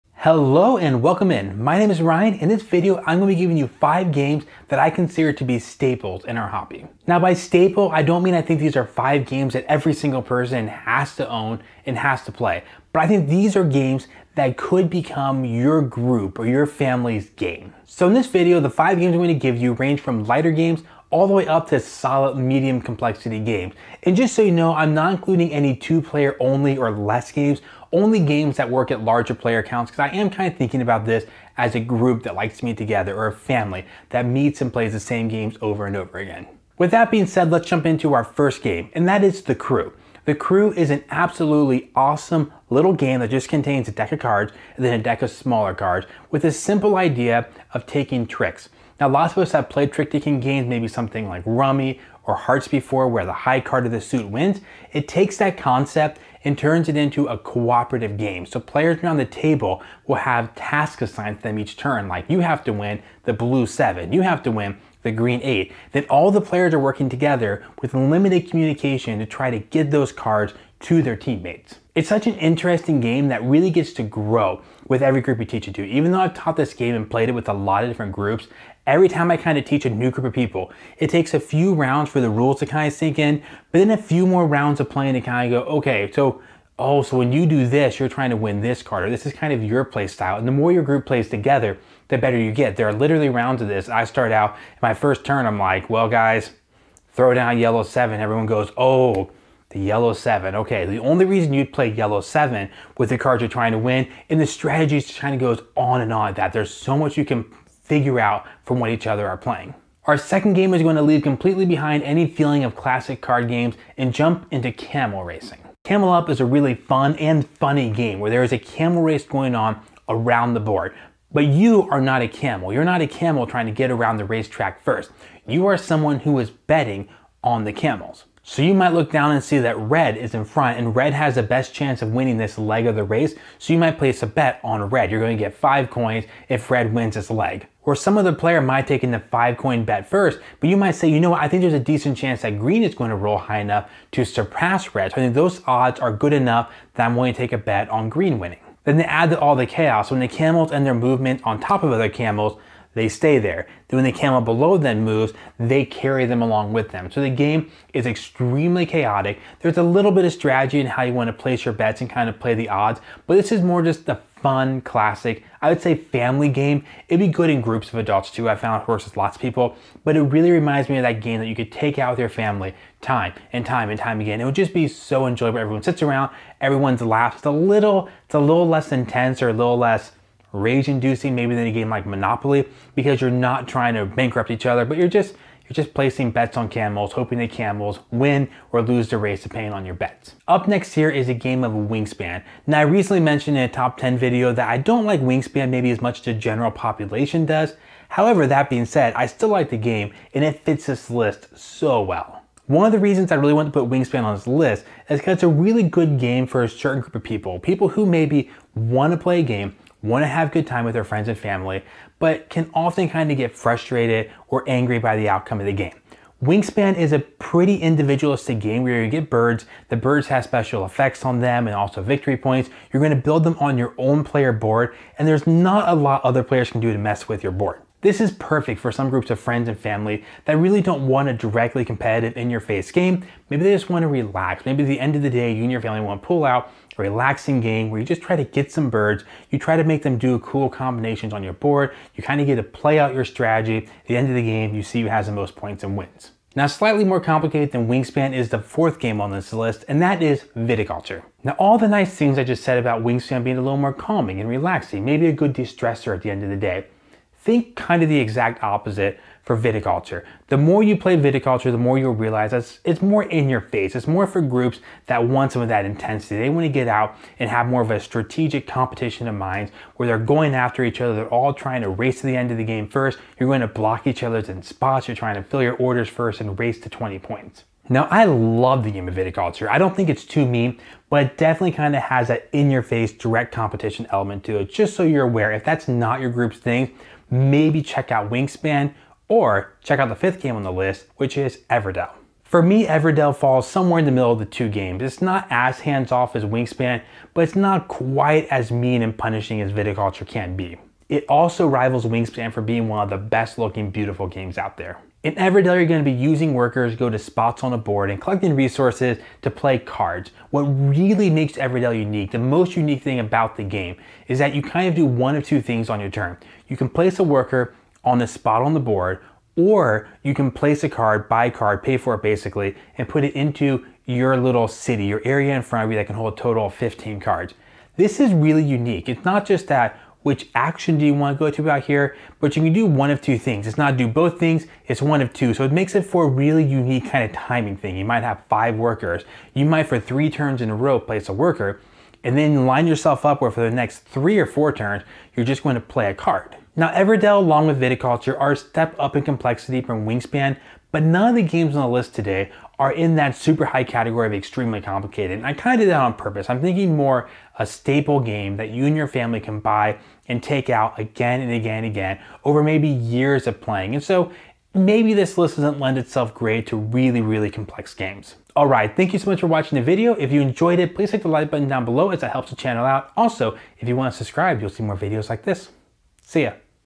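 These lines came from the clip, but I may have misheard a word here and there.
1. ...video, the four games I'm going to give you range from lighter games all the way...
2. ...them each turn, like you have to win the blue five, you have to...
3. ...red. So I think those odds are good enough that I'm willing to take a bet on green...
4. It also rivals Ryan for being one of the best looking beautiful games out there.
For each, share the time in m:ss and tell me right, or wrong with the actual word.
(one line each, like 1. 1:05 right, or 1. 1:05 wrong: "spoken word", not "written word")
1. 0:18 wrong: "five", not "four"
2. 1:01 wrong: "seven", not "five"
3. 2:24 right
4. 5:01 wrong: "Wingspan", not "Ryan".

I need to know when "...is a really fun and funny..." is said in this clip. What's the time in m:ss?
1:56.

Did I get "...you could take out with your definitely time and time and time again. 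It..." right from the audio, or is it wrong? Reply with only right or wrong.
wrong.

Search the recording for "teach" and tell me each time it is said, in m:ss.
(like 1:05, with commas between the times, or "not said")
1:15, 1:19.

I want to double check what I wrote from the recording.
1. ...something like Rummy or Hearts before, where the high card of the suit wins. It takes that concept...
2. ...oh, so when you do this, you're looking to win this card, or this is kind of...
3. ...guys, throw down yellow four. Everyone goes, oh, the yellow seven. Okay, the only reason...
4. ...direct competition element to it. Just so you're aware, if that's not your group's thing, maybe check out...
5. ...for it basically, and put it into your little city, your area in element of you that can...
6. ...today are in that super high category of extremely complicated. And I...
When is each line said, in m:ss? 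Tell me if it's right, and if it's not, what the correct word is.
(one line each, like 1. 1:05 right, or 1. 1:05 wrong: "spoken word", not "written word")
1. 0:50 right
2. 1:26 wrong: "trying", not "looking"
3. 1:36 wrong: "seven", not "four"
4. 4:43 right
5. 5:21 wrong: "front", not "element"
6. 5:52 right.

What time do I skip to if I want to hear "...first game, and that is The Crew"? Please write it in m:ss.
0:38.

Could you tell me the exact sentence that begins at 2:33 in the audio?
Then when the camel below them moves, they carry them along with them.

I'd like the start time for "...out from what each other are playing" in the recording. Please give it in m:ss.
1:48.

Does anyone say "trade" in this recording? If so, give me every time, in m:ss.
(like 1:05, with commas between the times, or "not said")
not said.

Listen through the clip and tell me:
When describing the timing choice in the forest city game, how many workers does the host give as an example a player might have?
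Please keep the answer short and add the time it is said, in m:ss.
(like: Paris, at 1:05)
5, at 5:38.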